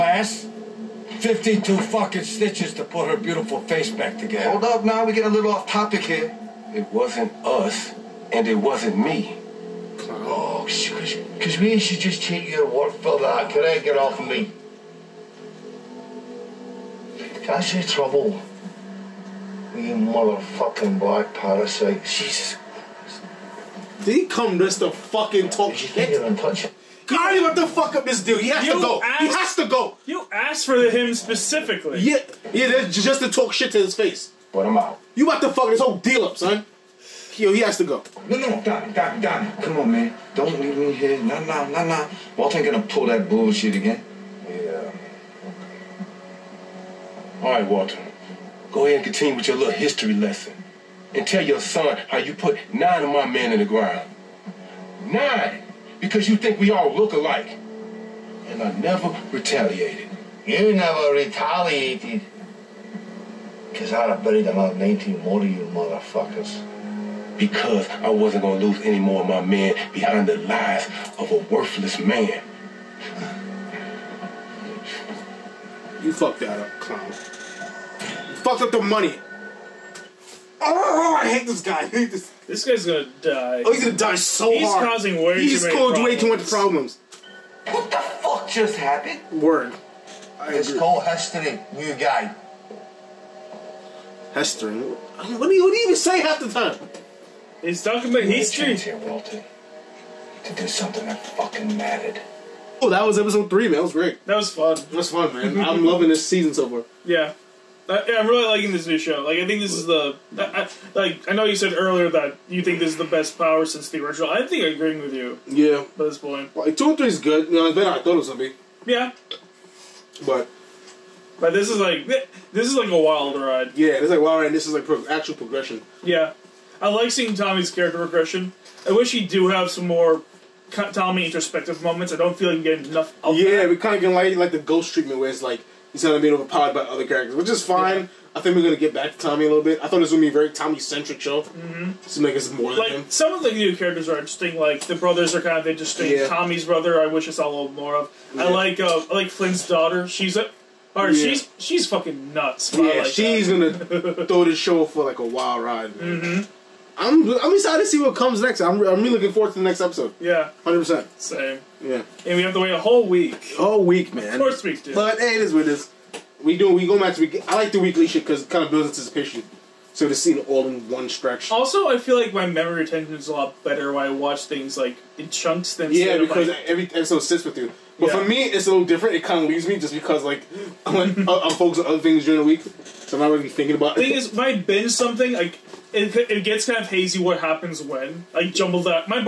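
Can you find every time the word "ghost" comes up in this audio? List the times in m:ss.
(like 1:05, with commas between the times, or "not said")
2:14.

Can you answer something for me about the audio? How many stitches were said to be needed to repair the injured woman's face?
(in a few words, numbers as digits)
52.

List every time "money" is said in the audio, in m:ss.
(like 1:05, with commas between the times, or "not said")
1:18.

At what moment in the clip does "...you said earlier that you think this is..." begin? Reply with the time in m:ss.
1:51.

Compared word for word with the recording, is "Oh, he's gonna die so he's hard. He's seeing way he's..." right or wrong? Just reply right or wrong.
wrong.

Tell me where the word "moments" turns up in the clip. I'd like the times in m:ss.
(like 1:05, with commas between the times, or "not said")
2:11.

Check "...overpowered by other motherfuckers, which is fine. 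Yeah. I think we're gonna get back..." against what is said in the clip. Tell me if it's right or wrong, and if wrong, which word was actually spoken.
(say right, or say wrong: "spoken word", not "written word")
wrong: "characters", not "motherfuckers".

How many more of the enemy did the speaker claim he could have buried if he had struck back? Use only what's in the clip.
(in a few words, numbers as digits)
19.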